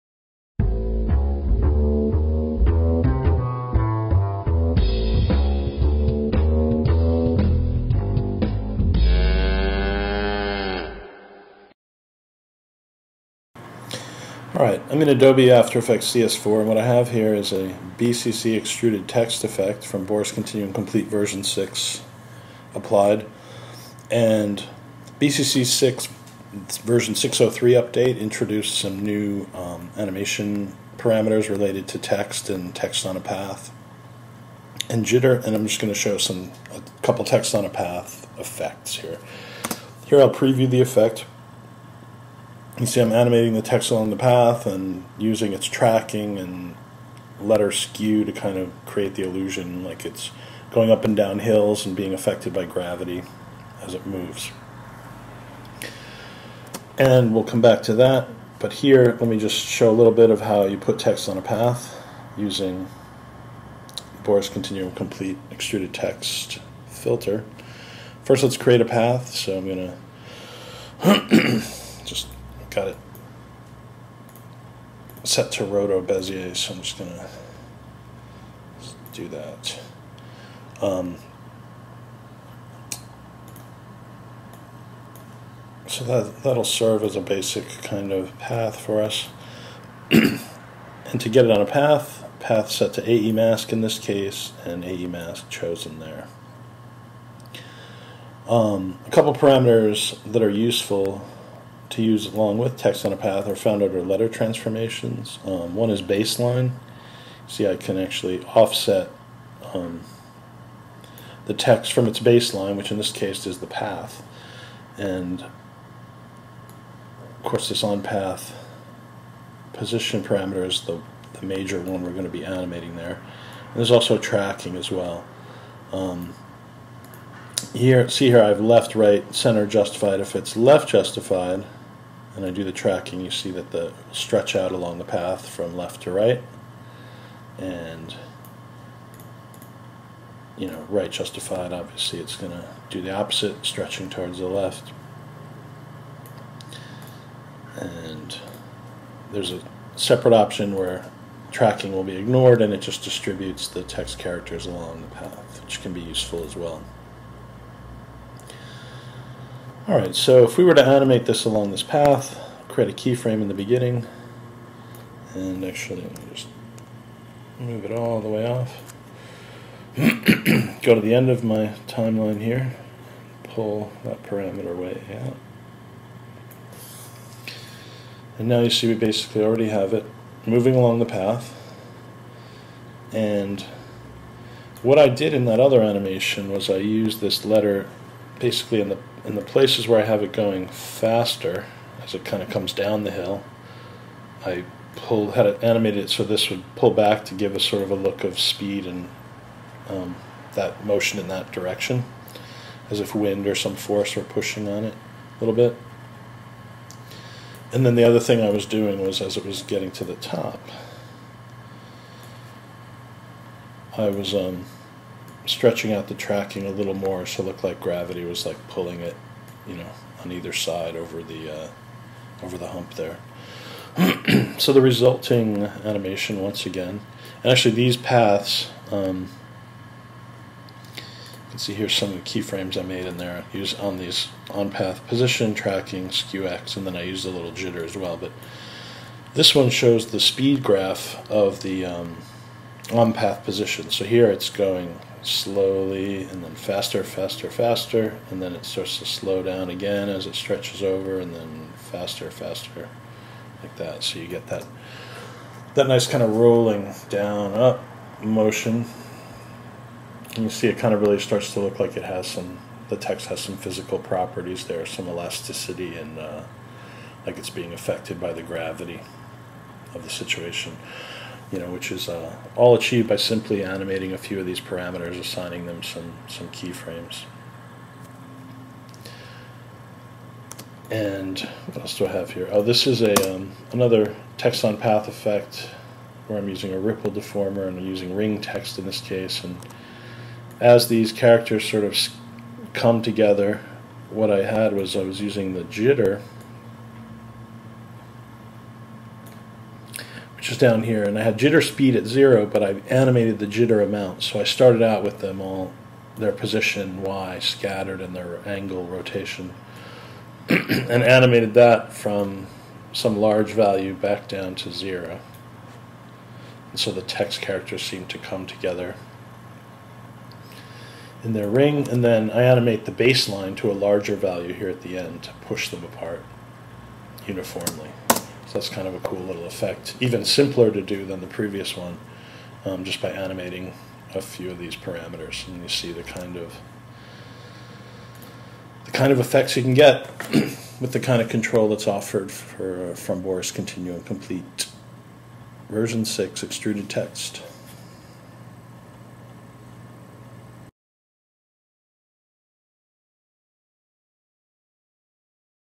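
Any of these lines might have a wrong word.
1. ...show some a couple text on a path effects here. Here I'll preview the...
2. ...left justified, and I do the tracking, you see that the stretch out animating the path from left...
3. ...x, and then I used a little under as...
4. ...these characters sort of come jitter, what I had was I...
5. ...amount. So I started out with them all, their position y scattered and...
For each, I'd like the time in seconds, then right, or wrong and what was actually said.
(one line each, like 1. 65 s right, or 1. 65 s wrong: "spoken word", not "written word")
1. 35 s right
2. 130 s wrong: "along", not "animating"
3. 236 s wrong: "jitter", not "under"
4. 290 s wrong: "together", not "jitter"
5. 303 s right.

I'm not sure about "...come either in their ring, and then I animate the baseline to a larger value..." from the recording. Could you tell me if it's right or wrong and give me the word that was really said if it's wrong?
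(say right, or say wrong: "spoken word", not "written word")
wrong: "together", not "either".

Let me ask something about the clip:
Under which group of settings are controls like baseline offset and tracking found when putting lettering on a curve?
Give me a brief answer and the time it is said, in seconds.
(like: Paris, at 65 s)
letter transformations, at 104 s.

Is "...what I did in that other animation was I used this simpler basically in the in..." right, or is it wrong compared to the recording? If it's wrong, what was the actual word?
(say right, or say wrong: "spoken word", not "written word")
wrong: "letter", not "simpler".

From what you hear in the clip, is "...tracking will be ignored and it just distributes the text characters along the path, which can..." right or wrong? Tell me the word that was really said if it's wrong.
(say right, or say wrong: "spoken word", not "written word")
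right.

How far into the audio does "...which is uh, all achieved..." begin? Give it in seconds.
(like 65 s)
271 s.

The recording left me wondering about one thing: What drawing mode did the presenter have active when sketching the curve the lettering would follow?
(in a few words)
roto bezier.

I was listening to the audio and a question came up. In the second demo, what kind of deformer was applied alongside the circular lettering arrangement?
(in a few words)
ripple.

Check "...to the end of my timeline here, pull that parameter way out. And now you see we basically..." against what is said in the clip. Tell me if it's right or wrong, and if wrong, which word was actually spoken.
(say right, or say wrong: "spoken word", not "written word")
right.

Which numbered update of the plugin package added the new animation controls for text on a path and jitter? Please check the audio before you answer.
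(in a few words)
603.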